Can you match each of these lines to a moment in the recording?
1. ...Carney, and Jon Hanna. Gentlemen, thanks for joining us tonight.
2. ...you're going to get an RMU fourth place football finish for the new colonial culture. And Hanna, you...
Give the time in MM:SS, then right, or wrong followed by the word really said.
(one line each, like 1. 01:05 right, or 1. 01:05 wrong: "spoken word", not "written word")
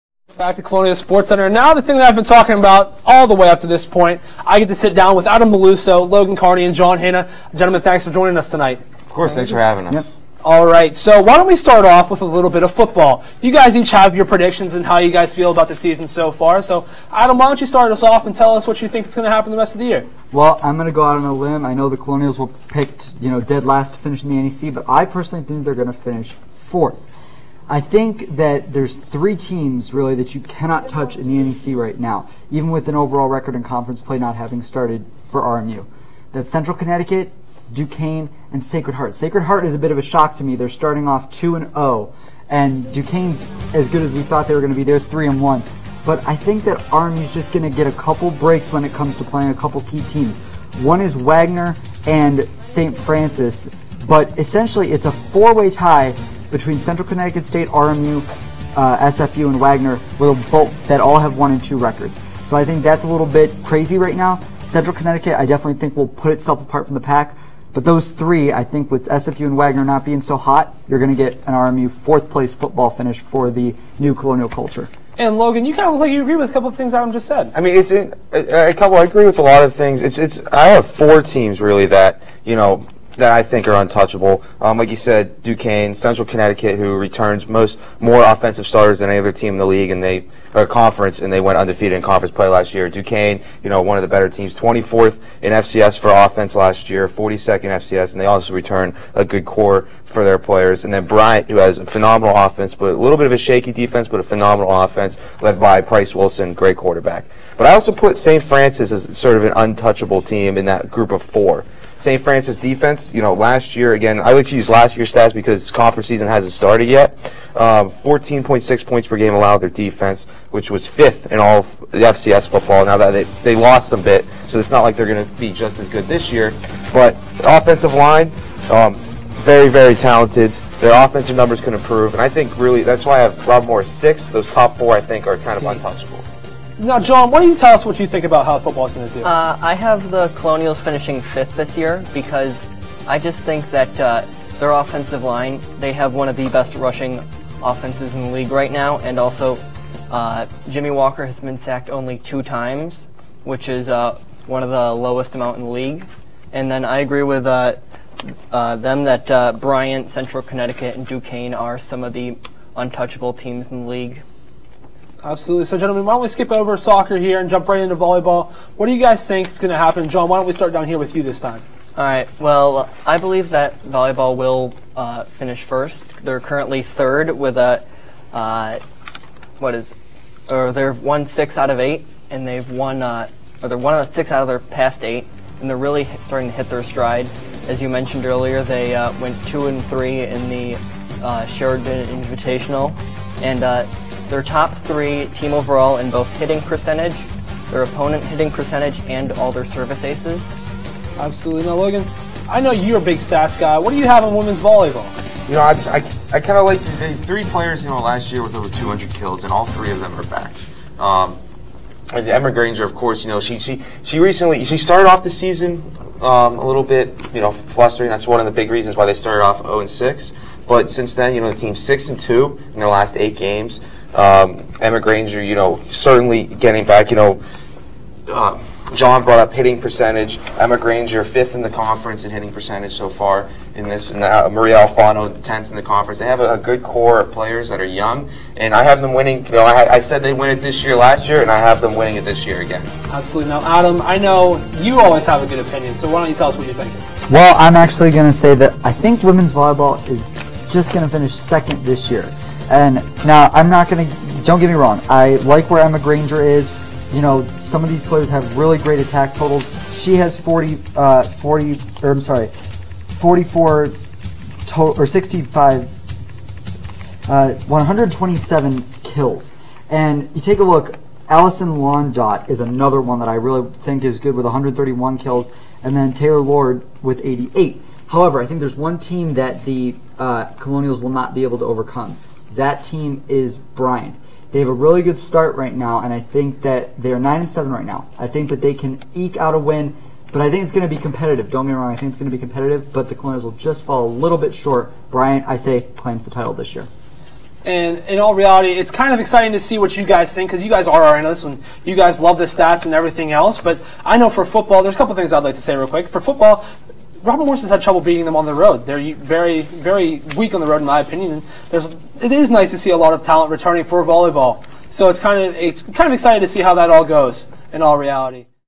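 1. 00:06 right
2. 01:10 wrong: "Logan", not "Hanna".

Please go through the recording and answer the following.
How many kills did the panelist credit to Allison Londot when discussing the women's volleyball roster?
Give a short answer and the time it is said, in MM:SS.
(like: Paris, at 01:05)
131, at 04:34.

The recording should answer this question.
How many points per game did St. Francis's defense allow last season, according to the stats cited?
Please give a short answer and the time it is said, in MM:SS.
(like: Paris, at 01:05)
14.6, at 01:57.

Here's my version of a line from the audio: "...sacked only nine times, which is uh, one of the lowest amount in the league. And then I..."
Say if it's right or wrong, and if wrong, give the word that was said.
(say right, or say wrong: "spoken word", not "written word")
wrong: "two", not "nine".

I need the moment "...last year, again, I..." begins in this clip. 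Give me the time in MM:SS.
01:53.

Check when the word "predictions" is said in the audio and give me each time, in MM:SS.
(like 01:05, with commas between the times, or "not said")
00:14.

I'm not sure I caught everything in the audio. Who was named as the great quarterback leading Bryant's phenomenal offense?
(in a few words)
Price Wilson.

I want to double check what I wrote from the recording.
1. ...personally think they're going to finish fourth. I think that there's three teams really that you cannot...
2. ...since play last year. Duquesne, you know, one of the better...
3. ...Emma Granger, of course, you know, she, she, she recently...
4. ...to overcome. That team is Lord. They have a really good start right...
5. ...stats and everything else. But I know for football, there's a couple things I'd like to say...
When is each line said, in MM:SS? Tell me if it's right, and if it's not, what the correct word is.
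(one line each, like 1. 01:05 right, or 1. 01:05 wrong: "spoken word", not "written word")
1. 00:25 right
2. 01:32 wrong: "conference", not "since"
3. 03:32 right
4. 04:41 wrong: "Bryant", not "Lord"
5. 05:02 right.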